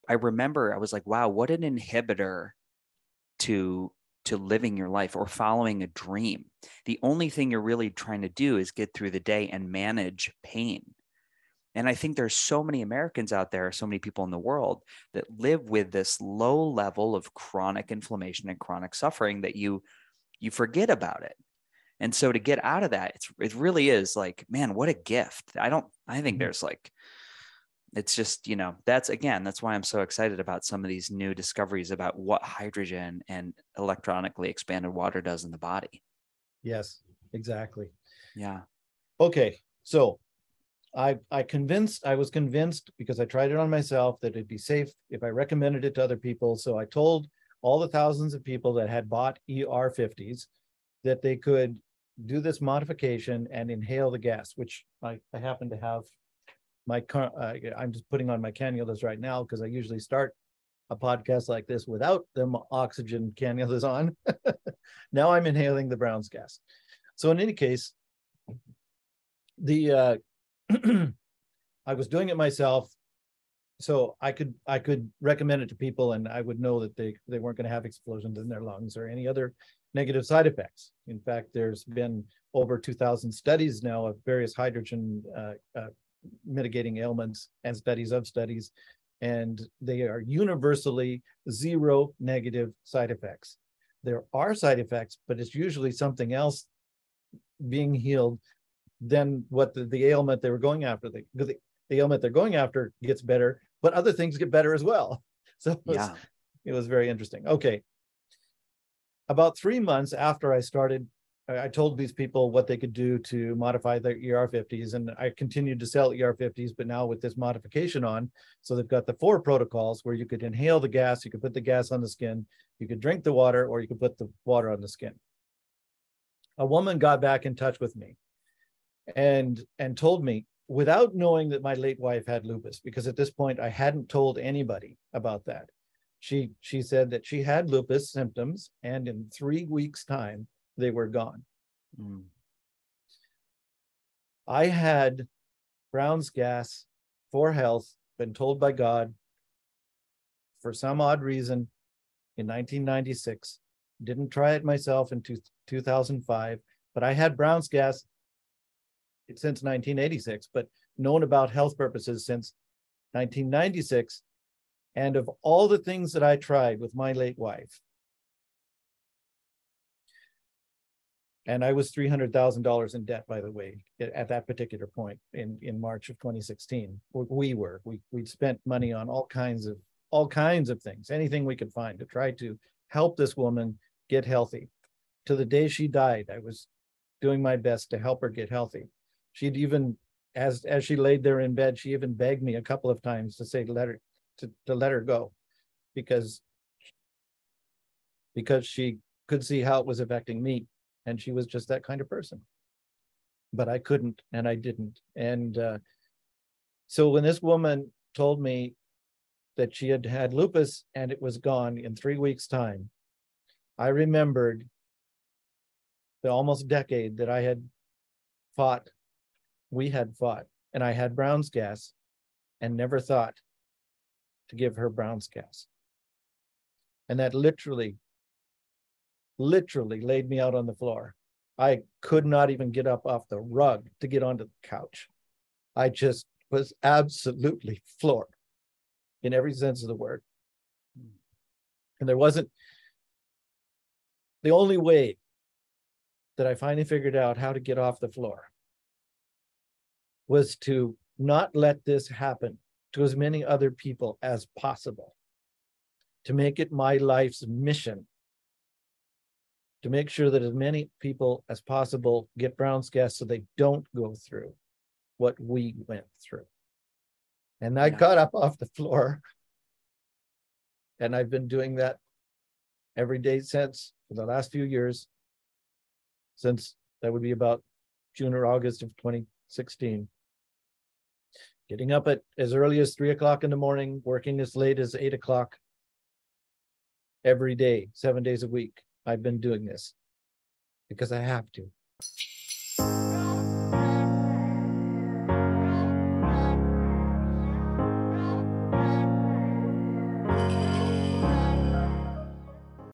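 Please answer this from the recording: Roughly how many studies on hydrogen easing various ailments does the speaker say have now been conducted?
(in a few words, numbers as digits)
over 2,000.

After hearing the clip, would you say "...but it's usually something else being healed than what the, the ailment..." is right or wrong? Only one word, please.
right.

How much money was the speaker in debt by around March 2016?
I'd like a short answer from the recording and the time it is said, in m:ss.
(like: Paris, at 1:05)
$300,000, at 2:51.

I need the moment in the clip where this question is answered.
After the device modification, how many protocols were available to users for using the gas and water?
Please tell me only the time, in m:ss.
1:59.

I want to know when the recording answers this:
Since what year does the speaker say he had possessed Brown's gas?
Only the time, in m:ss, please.
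2:39.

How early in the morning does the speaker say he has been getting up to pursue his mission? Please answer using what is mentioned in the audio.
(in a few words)
3 o'clock.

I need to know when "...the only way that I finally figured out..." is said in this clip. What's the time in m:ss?
4:04.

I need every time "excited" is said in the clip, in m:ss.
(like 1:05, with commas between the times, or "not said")
0:30.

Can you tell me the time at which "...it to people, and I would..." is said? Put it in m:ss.
1:15.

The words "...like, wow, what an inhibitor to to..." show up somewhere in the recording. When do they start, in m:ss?
0:00.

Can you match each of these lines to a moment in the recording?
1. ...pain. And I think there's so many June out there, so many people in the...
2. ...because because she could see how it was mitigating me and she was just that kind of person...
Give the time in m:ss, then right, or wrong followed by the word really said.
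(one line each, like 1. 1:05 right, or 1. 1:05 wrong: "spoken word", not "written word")
1. 0:10 wrong: "Americans", not "June"
2. 3:15 wrong: "affecting", not "mitigating".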